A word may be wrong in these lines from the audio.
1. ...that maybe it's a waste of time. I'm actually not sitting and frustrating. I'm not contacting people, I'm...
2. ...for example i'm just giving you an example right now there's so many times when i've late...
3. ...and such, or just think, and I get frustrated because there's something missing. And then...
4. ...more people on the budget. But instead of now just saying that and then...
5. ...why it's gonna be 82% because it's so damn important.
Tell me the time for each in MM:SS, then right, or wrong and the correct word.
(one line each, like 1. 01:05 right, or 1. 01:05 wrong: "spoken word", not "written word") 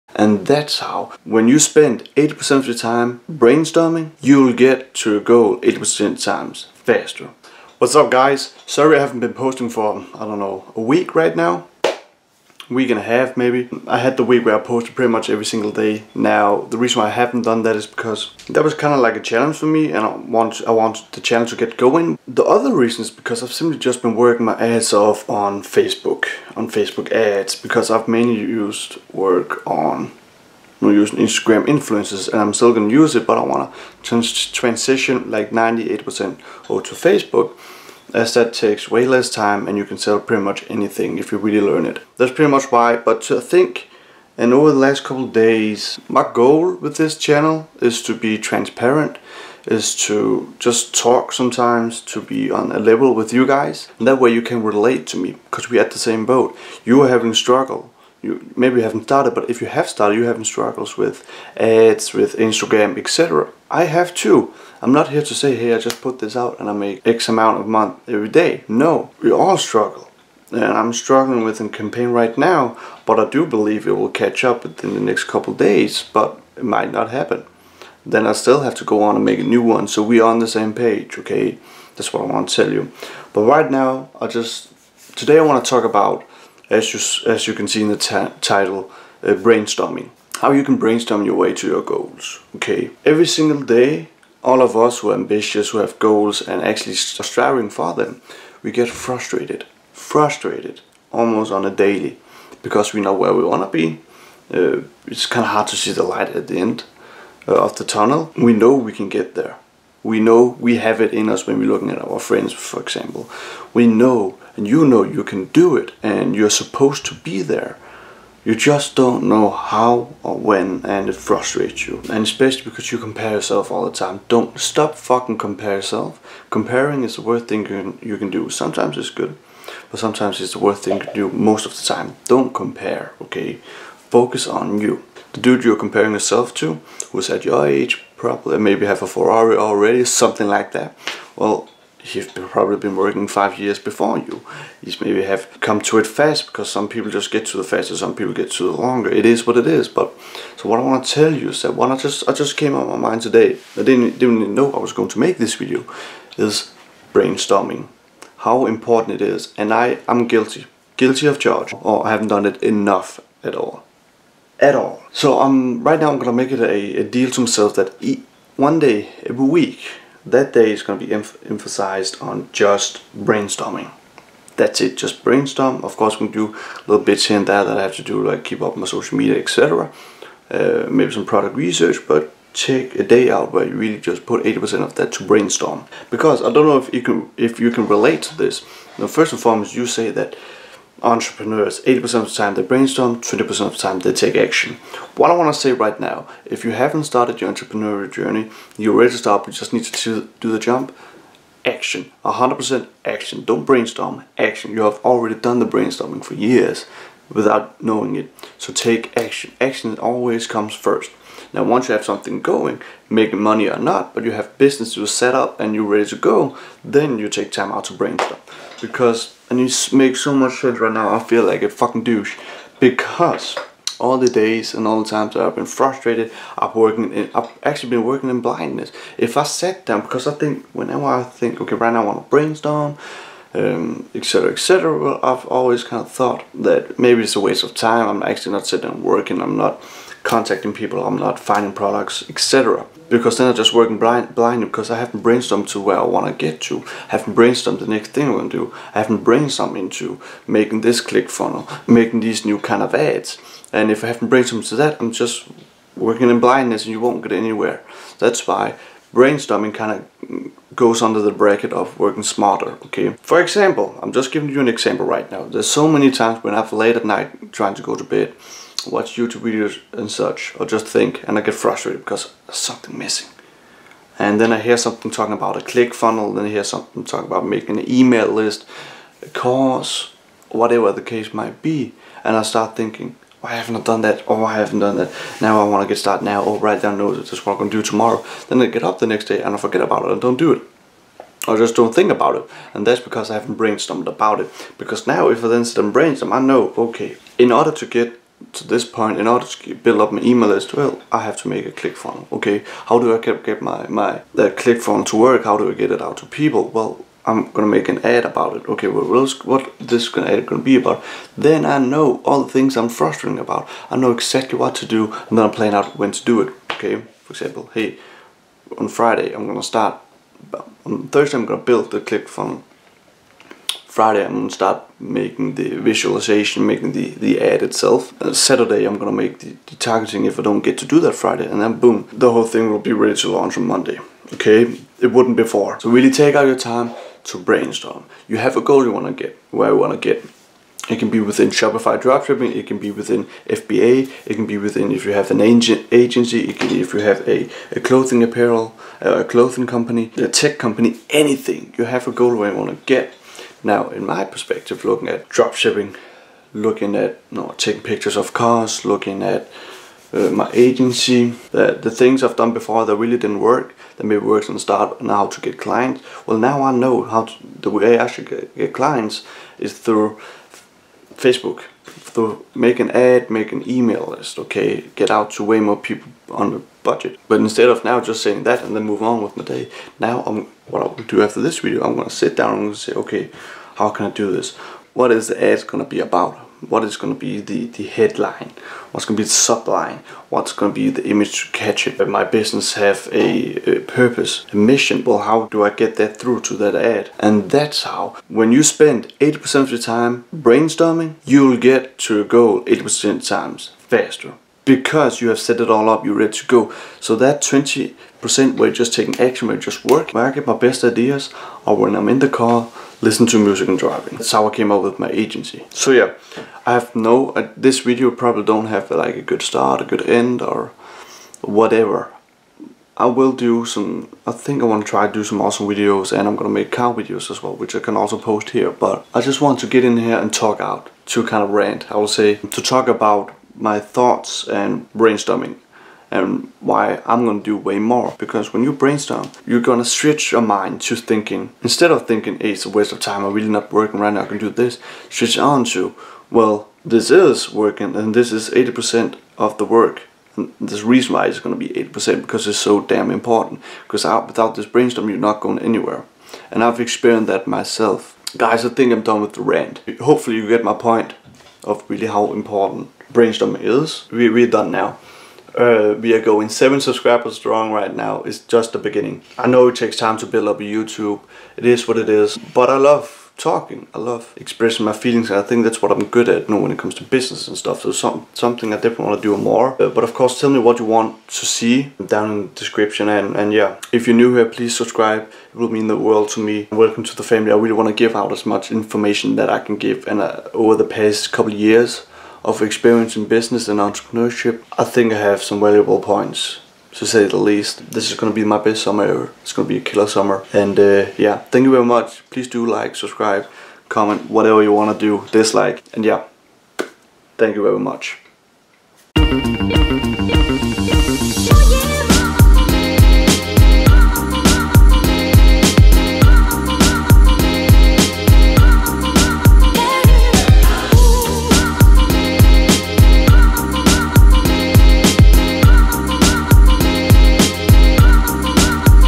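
1. 03:56 wrong: "working", not "frustrating"
2. 04:23 right
3. 04:29 right
4. 06:15 right
5. 07:31 wrong: "80", not "82".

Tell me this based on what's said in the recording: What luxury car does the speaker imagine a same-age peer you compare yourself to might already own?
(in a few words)
Ferrari.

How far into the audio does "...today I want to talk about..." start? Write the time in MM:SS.
01:25.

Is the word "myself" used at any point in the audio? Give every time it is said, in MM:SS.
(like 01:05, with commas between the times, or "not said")
02:47, 07:37.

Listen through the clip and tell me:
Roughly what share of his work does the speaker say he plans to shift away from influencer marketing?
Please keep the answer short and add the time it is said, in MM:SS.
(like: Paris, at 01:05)
98%, at 00:35.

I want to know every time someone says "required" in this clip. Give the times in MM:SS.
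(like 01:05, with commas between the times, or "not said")
not said.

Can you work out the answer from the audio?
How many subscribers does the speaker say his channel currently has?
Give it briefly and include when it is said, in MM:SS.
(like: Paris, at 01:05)
7, at 07:46.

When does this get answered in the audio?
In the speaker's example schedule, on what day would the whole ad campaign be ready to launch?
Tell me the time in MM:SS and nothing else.
05:33.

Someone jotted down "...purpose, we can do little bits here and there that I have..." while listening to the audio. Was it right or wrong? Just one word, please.
wrong.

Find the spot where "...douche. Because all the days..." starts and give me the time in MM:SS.
03:42.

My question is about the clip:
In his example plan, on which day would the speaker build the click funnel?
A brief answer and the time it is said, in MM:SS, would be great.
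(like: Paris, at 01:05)
Thursday, at 05:20.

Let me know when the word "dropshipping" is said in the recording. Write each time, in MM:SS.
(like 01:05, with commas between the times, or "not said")
05:42, 05:55.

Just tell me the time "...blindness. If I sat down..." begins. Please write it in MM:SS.
03:48.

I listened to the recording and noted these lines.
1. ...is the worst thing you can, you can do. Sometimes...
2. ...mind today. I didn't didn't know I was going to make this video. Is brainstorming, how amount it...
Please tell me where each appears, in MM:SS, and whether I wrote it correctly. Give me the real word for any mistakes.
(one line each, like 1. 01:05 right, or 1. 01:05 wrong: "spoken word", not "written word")
1. 02:07 right
2. 02:33 wrong: "important", not "amount".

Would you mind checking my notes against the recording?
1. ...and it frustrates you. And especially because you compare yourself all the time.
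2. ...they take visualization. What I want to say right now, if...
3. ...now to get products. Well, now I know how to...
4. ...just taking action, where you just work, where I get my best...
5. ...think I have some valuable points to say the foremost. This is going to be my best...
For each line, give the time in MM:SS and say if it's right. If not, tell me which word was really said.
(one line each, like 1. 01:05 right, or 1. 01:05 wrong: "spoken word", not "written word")
1. 02:00 right
2. 03:13 wrong: "action", not "visualization"
3. 06:05 wrong: "clients", not "products"
4. 06:48 right
5. 08:14 wrong: "least", not "foremost".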